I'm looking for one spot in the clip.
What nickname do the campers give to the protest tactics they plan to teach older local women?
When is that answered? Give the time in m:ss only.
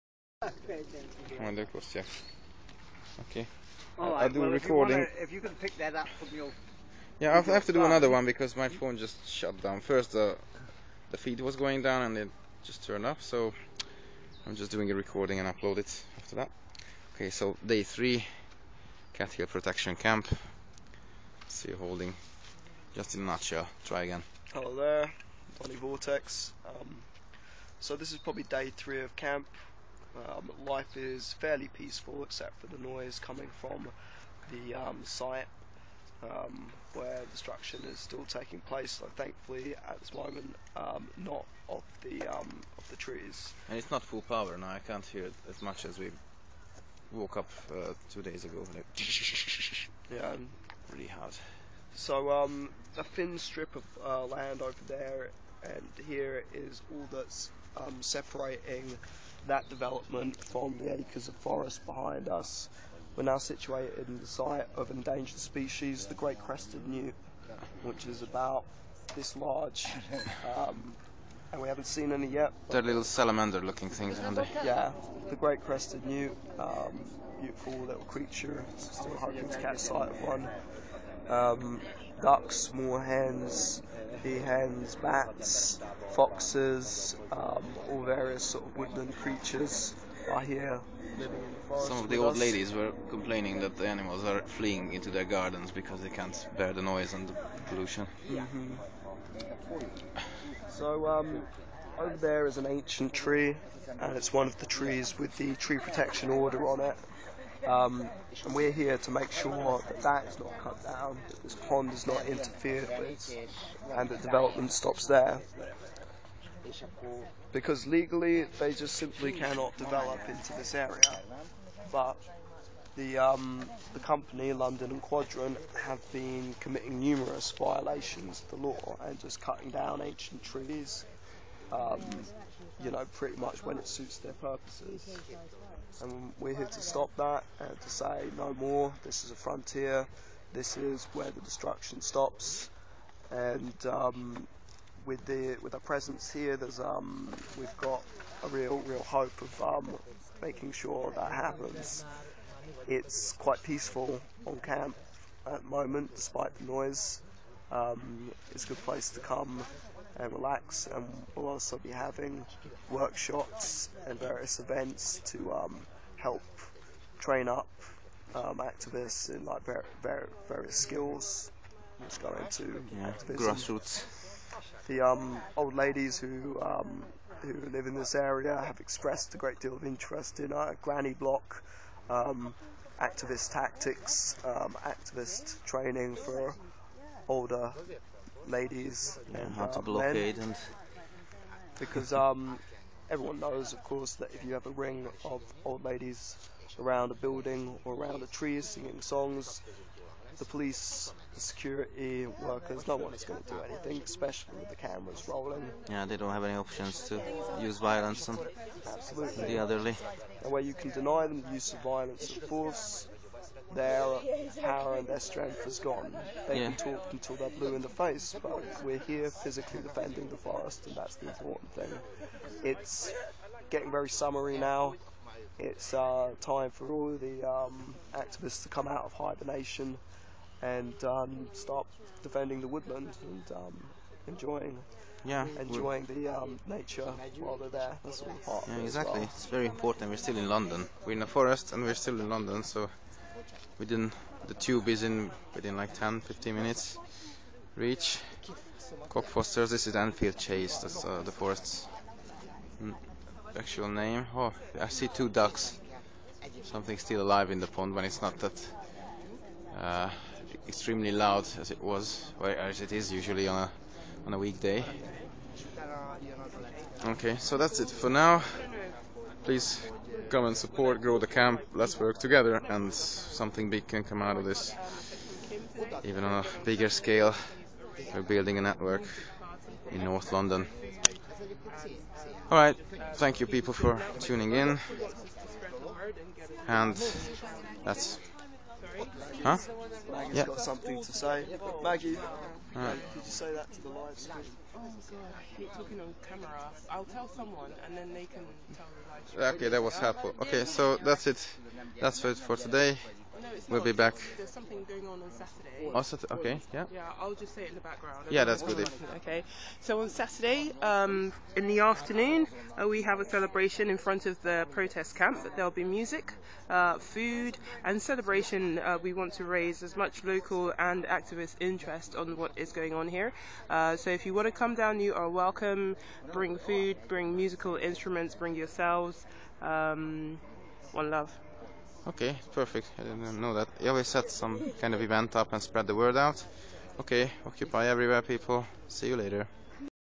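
3:00.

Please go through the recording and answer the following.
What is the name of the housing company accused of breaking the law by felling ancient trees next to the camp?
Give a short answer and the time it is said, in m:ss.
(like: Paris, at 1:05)
London and Quadrant, at 2:04.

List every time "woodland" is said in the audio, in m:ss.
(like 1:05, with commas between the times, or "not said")
1:28, 3:52.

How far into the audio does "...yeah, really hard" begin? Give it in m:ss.
0:50.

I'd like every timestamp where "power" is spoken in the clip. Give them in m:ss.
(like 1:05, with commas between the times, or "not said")
0:44, 3:34.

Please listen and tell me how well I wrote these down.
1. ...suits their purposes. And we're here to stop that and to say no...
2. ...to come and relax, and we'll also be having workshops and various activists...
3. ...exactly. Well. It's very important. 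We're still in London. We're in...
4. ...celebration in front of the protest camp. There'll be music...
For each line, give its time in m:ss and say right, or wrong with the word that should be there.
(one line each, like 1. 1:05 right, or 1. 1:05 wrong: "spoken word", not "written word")
1. 2:13 right
2. 2:39 wrong: "events", not "activists"
3. 3:58 right
4. 5:13 right.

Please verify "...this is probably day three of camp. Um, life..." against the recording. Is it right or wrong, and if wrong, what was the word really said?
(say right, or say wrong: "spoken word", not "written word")
right.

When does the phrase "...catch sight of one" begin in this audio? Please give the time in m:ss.
1:19.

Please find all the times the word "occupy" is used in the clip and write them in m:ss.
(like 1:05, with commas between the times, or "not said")
5:37.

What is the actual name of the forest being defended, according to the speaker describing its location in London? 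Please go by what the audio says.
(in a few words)
Enfield Chase.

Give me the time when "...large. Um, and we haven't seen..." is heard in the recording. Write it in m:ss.
1:09.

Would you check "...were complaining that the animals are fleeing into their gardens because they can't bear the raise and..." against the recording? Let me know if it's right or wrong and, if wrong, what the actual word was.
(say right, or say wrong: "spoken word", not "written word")
wrong: "noise", not "raise".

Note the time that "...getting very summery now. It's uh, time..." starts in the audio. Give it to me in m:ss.
3:43.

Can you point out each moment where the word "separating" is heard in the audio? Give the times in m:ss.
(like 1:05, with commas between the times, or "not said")
0:58.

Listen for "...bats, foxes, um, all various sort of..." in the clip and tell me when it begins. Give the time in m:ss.
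1:24.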